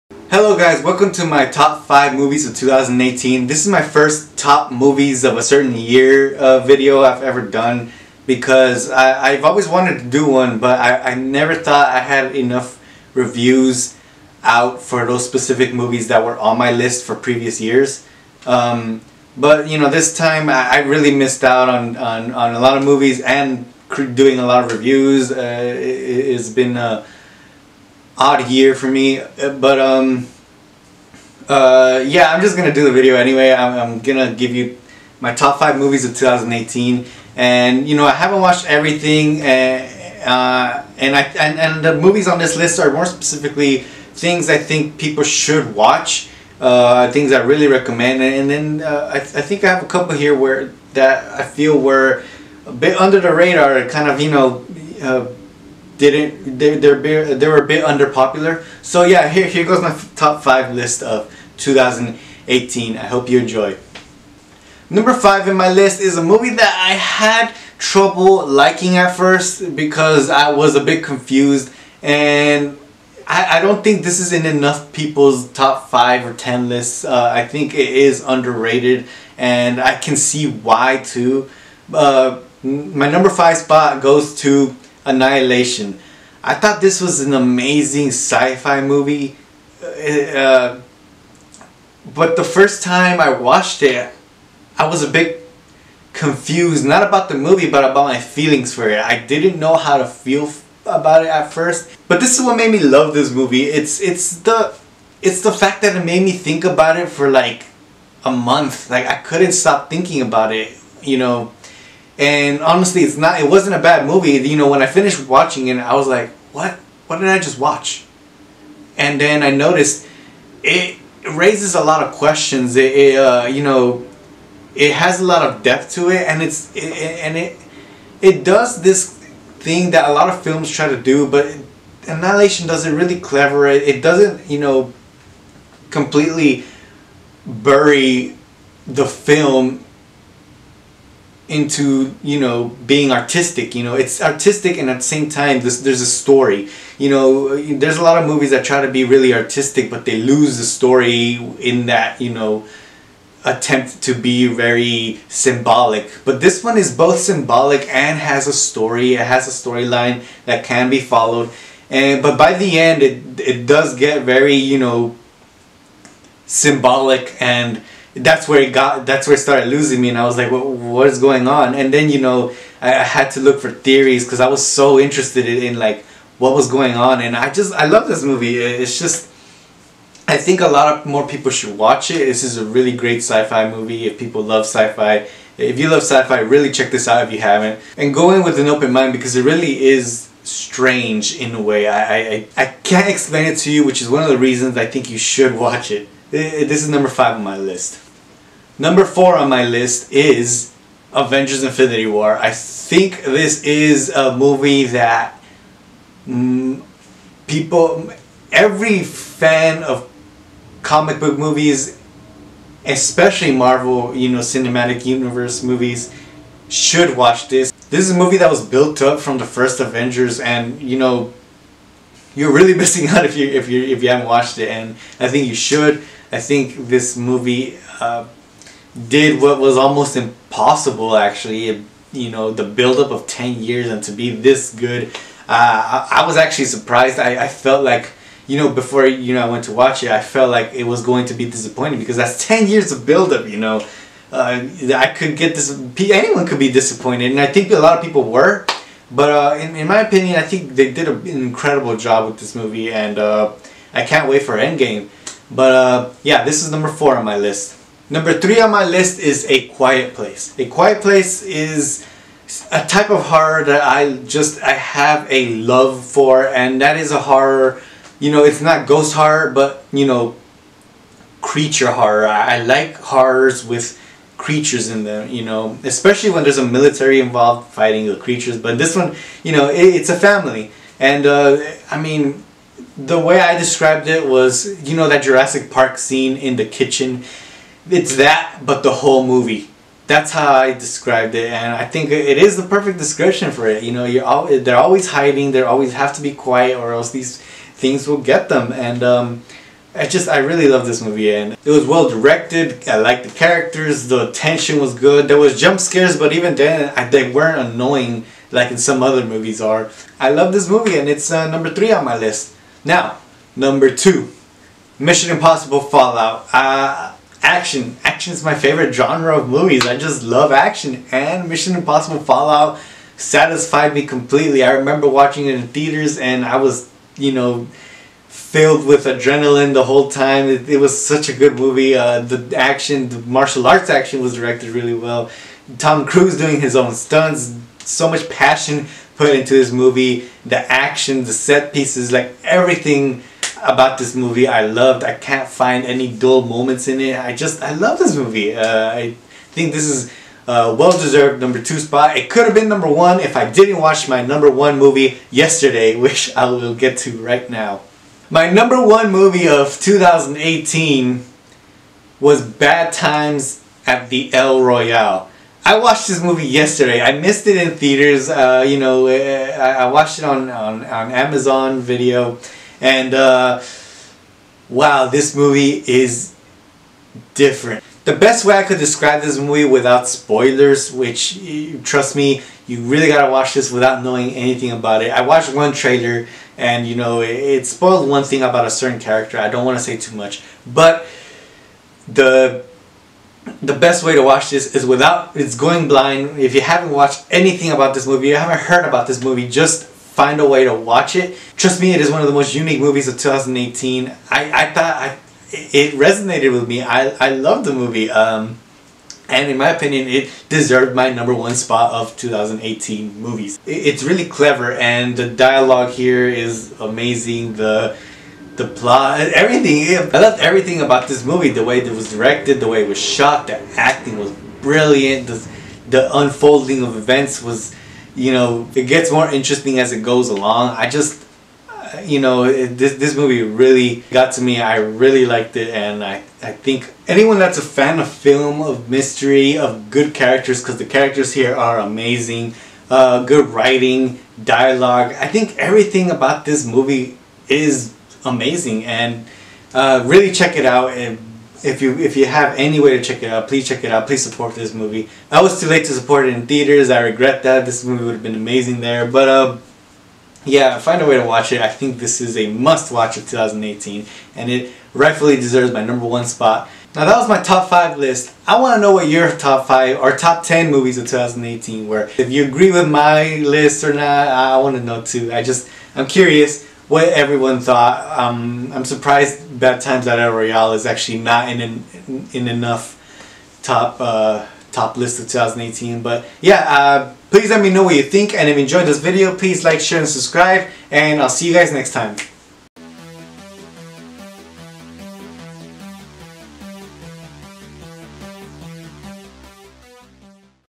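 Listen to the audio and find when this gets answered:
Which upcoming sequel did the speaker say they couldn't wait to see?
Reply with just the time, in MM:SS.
04:14.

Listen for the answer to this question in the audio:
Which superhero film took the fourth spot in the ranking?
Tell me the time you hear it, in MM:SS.
03:21.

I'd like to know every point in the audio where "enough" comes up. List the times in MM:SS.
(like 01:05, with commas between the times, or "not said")
00:12, 01:14, 08:02.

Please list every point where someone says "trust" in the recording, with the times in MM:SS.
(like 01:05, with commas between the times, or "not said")
06:21, 06:41.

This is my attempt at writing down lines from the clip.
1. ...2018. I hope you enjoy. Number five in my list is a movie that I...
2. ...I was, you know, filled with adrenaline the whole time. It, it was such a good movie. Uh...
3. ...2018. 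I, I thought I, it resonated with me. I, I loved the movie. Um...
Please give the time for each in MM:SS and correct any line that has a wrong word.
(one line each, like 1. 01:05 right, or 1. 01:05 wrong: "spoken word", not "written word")
1. 01:01 right
2. 05:26 right
3. 06:43 right.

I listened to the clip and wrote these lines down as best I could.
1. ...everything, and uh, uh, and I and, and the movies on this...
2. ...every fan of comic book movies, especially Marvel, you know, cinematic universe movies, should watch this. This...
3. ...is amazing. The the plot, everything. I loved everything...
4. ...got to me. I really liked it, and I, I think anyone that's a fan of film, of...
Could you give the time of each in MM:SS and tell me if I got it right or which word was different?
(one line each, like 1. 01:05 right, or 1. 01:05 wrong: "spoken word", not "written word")
1. 00:38 right
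2. 03:28 right
3. 06:56 right
4. 07:14 right.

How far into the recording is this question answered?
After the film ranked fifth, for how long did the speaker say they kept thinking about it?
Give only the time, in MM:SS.
01:48.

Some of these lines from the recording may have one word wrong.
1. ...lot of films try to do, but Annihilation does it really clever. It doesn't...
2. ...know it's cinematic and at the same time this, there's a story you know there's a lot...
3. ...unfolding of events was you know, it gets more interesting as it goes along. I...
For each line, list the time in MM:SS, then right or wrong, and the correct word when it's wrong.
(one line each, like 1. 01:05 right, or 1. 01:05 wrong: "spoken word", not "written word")
1. 02:10 right
2. 02:23 wrong: "artistic", not "cinematic"
3. 07:06 right.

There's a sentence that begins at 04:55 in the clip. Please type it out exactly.
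They always have to be quiet, or else these things will get them.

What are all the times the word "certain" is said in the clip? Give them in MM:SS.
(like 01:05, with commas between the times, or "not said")
00:05, 06:28.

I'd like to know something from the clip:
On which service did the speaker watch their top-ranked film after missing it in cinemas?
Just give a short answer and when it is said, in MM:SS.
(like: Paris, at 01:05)
Amazon Video, at 06:11.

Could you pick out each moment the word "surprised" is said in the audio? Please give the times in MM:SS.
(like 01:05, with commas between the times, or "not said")
03:56, 07:58.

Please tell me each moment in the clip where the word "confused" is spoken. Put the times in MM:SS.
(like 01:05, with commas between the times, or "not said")
01:11, 01:36.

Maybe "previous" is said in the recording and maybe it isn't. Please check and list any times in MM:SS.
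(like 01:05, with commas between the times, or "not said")
00:17.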